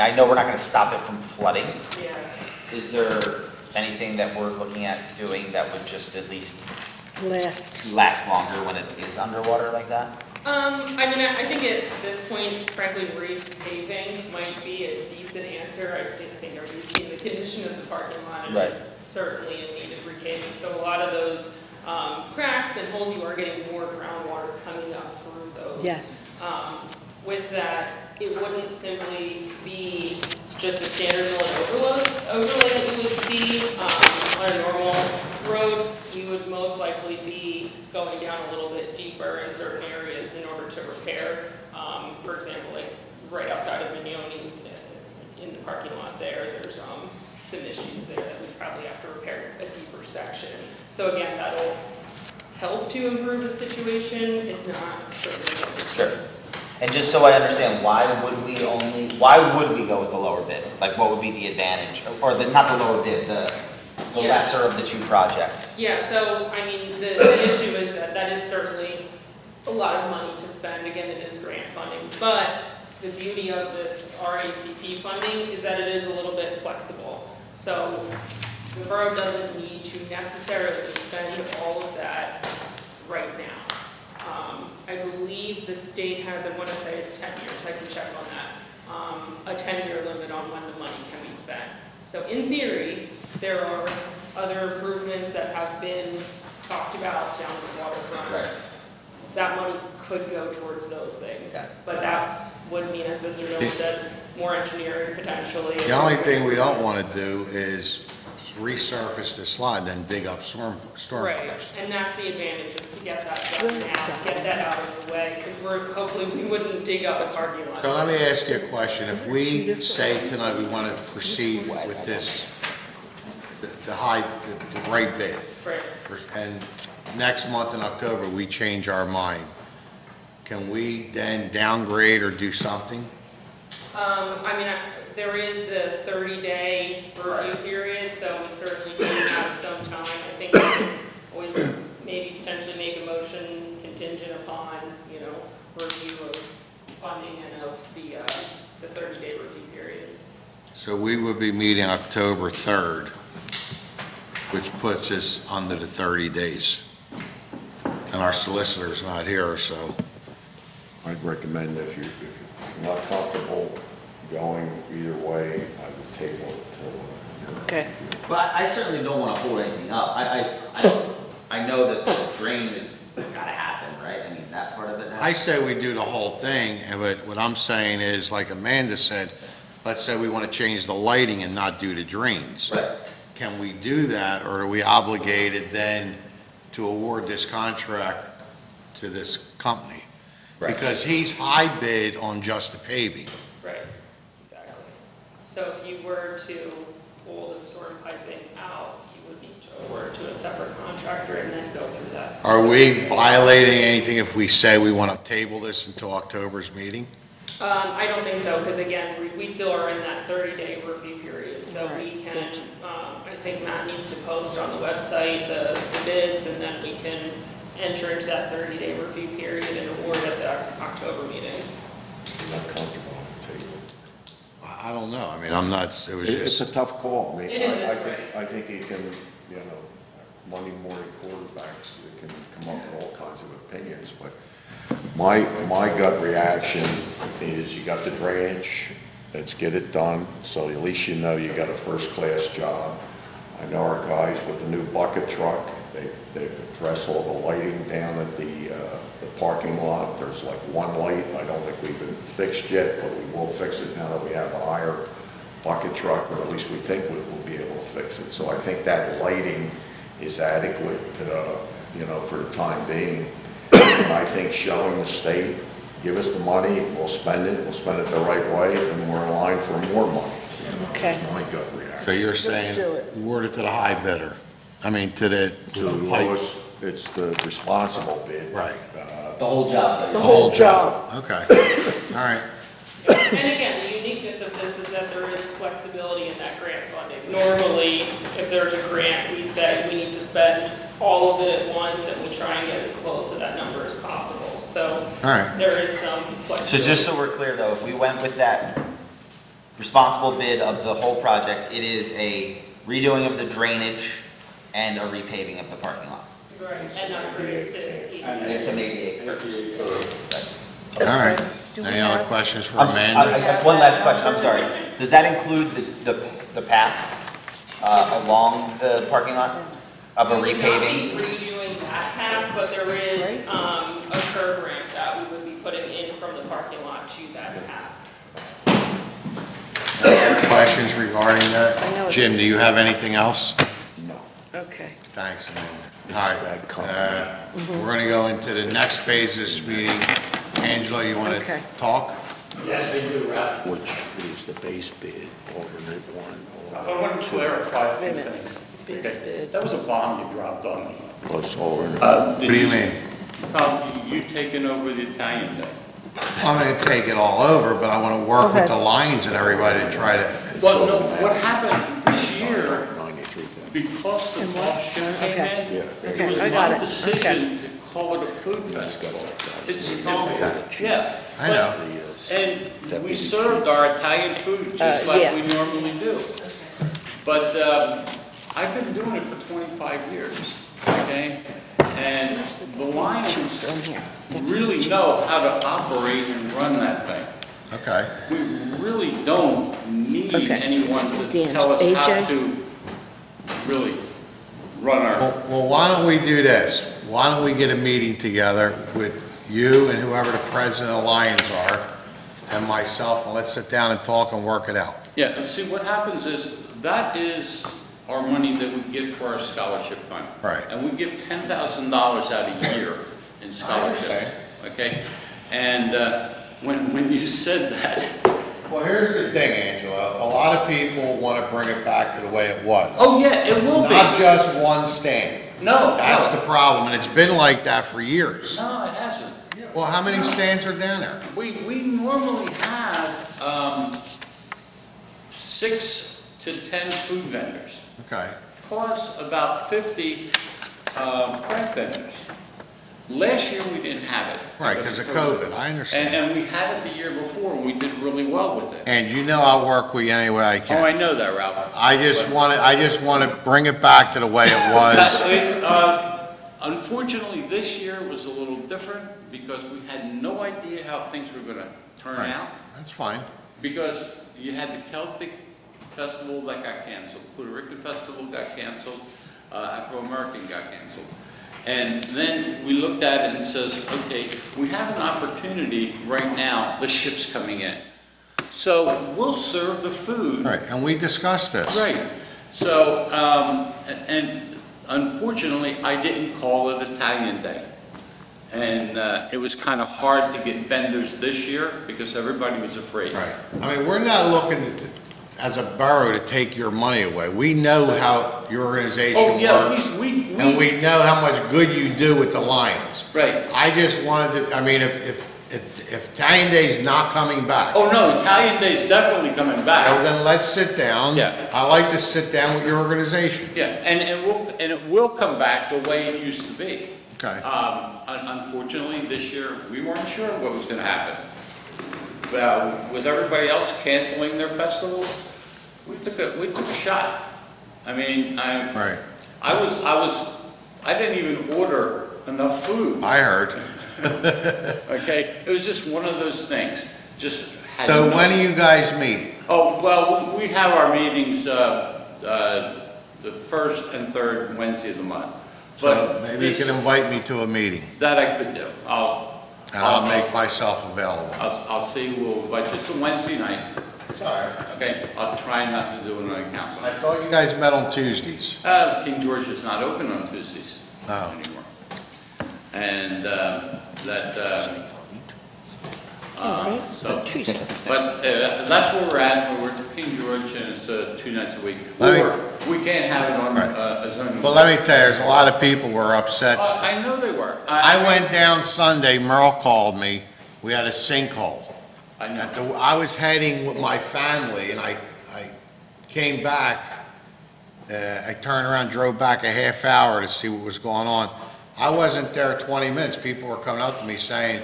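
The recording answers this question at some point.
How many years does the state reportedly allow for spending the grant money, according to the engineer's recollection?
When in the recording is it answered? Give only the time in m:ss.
1:29.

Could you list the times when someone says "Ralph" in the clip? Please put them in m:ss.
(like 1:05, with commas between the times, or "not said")
5:43, 7:31.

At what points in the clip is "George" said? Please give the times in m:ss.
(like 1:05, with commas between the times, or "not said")
9:19, 9:30.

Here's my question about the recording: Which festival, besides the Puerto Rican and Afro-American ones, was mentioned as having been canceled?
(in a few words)
Celtic festival.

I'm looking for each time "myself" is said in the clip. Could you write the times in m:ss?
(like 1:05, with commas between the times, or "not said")
6:42, 9:10.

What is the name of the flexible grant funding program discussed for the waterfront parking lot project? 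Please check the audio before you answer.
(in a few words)
RACP.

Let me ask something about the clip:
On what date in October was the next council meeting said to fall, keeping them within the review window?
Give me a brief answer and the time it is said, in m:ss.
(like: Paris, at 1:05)
October 3rd, at 2:31.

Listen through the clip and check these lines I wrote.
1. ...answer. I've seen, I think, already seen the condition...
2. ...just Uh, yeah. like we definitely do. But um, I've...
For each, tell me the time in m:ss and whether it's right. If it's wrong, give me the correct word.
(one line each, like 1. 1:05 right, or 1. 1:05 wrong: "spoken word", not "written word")
1. 0:15 right
2. 6:14 wrong: "normally", not "definitely".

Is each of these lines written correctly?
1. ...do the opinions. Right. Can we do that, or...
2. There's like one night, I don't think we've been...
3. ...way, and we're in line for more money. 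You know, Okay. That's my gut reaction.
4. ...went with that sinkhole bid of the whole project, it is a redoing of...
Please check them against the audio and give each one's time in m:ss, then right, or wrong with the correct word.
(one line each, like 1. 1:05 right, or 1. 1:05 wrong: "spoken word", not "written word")
1. 3:01 wrong: "drains", not "opinions"
2. 4:10 wrong: "light", not "night"
3. 4:28 right
4. 4:57 wrong: "responsible", not "sinkhole".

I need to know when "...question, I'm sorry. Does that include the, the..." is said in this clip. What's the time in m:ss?
5:14.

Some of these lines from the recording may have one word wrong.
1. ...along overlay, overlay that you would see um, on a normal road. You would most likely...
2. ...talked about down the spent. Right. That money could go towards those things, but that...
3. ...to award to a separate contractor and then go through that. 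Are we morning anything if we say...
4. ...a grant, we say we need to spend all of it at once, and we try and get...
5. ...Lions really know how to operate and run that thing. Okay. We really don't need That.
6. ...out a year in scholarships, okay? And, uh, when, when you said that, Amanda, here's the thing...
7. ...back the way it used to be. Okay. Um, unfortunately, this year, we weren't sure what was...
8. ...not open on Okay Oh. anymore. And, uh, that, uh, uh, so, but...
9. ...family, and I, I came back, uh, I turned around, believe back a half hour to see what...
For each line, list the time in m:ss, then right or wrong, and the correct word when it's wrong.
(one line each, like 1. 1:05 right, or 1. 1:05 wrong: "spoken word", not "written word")
1. 0:31 wrong: "building", not "along"
2. 1:36 wrong: "waterfront", not "spent"
3. 3:19 wrong: "violating", not "morning"
4. 4:48 right
5. 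6:22 wrong: "Okay", not "That"
6. 6:52 wrong: "Well", not "Amanda"
7. 8:35 right
8. 9:19 wrong: "Tuesdays", not "Okay"
9. 9:43 wrong: "drove", not "believe".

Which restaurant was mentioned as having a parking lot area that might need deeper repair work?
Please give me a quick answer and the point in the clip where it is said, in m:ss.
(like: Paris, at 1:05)
Mignoni's, at 0:43.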